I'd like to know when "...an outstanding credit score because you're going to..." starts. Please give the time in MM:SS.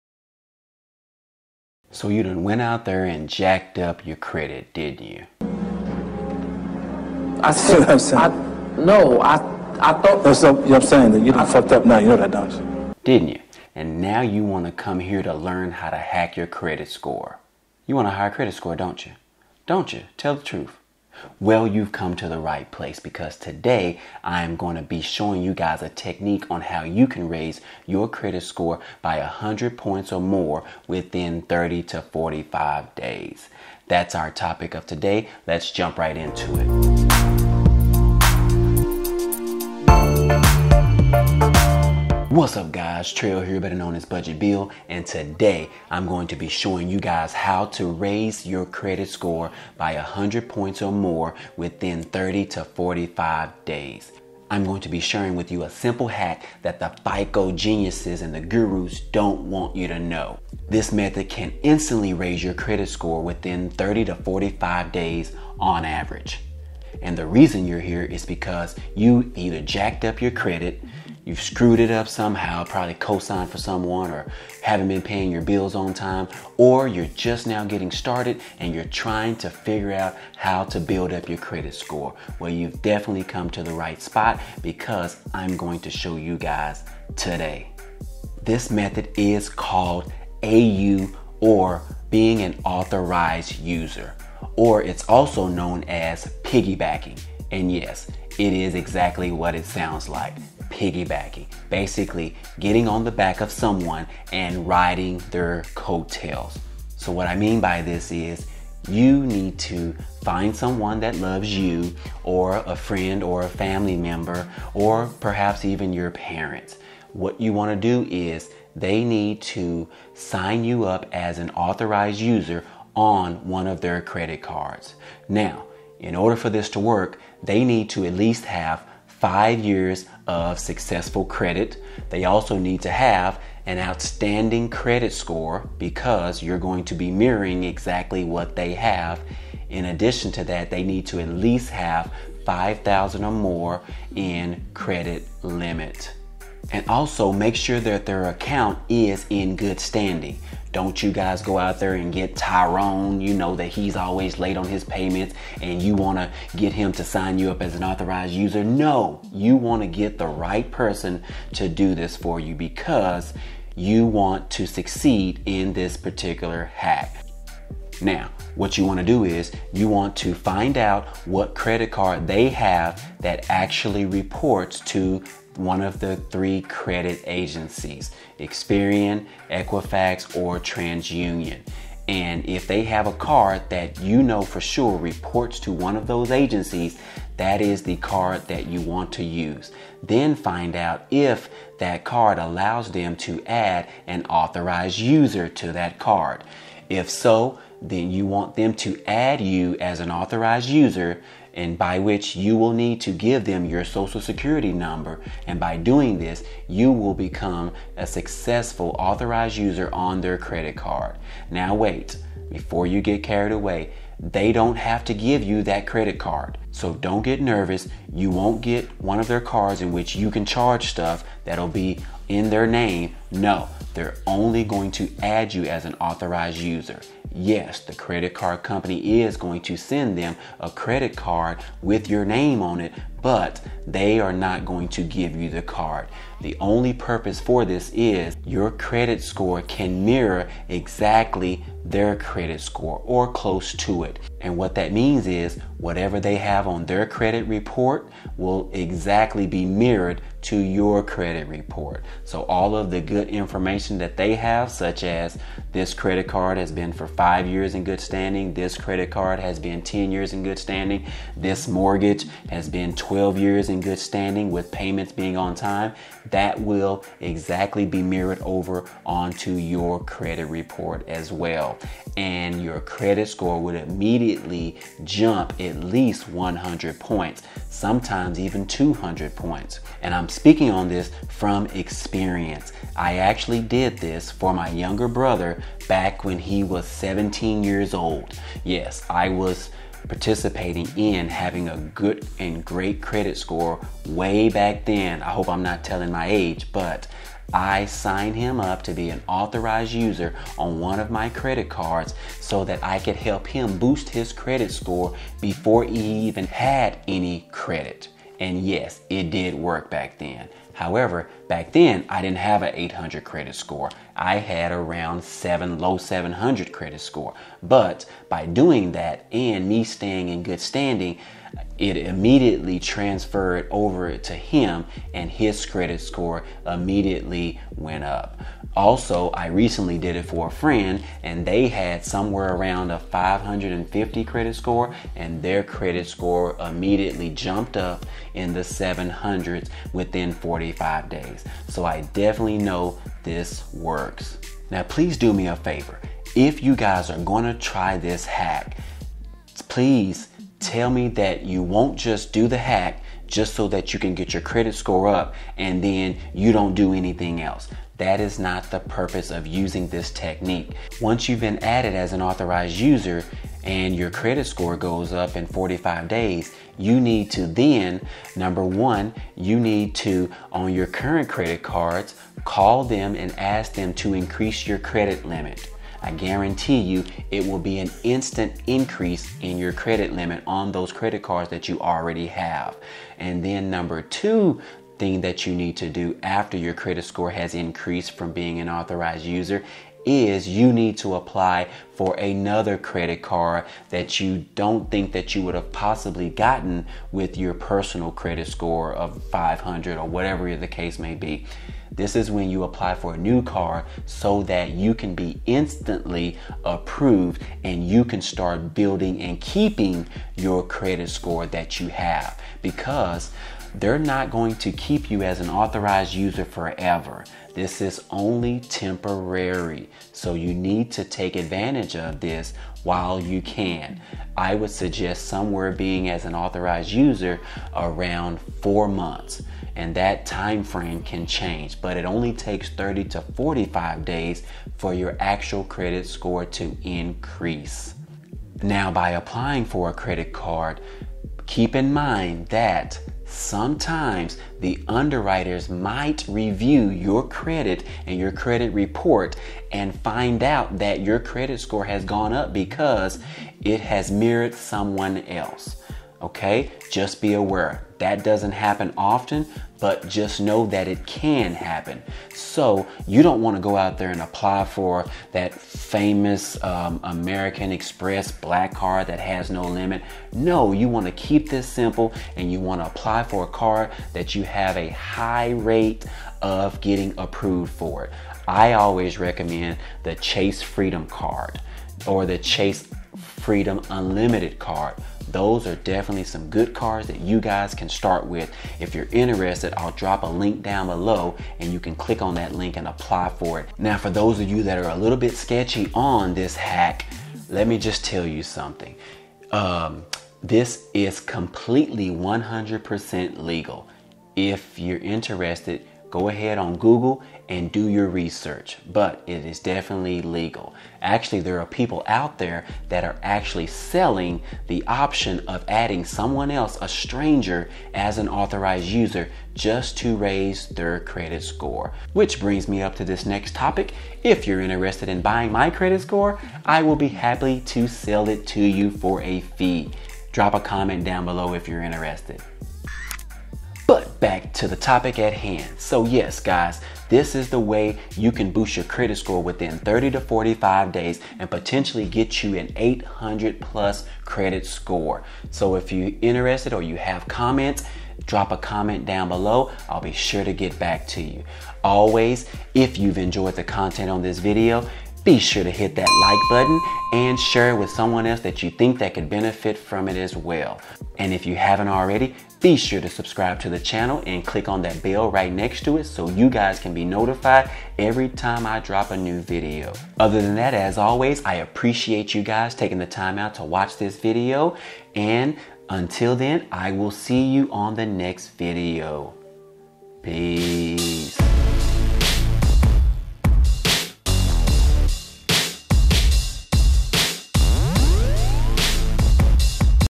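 02:13.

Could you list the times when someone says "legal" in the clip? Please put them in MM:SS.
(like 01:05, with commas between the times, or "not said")
08:23, 08:30.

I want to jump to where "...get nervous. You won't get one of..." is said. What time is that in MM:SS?
03:37.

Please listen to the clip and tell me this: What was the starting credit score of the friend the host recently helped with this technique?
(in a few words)
550.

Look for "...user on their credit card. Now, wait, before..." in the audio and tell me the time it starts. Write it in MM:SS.
03:29.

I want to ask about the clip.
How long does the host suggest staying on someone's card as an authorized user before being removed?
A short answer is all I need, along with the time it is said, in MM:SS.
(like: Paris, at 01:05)
4 months, at 07:08.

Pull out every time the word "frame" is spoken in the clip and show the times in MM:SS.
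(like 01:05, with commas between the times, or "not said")
07:10.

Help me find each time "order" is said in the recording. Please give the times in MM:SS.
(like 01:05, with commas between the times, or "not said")
02:06.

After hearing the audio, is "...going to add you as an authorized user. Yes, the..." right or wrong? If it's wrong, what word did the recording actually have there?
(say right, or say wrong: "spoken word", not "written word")
right.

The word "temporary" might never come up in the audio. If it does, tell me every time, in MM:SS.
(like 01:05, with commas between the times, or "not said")
06:58.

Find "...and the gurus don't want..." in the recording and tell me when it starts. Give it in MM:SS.
00:58.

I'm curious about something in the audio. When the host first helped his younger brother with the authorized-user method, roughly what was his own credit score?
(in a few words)
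low 700.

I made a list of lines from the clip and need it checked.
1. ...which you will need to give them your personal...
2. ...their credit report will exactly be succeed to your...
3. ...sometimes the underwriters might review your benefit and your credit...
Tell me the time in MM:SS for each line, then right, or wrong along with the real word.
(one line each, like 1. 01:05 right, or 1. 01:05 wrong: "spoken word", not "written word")
1. 03:21 wrong: "social", not "personal"
2. 04:06 wrong: "mirrored", not "succeed"
3. 07:23 wrong: "credit", not "benefit".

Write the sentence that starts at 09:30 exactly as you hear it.
Other than that, as always, I appreciate you guys taking the time out to watch this video.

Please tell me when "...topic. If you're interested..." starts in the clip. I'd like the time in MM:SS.
08:43.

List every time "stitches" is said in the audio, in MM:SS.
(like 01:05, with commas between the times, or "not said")
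not said.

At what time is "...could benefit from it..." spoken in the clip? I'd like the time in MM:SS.
09:19.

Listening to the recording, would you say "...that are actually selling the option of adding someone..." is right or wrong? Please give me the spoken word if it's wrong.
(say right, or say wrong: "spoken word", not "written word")
right.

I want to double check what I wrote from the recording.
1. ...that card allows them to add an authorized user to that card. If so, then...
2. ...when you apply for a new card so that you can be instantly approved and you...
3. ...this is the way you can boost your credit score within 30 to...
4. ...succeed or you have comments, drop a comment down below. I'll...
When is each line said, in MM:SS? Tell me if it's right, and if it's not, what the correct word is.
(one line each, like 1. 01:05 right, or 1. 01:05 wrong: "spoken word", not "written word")
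1. 03:11 right
2. 06:42 right
3. 08:57 right
4. 09:06 wrong: "interested", not "succeed".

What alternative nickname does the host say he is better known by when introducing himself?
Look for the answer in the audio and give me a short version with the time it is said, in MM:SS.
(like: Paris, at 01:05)
Budget Bill, at 00:44.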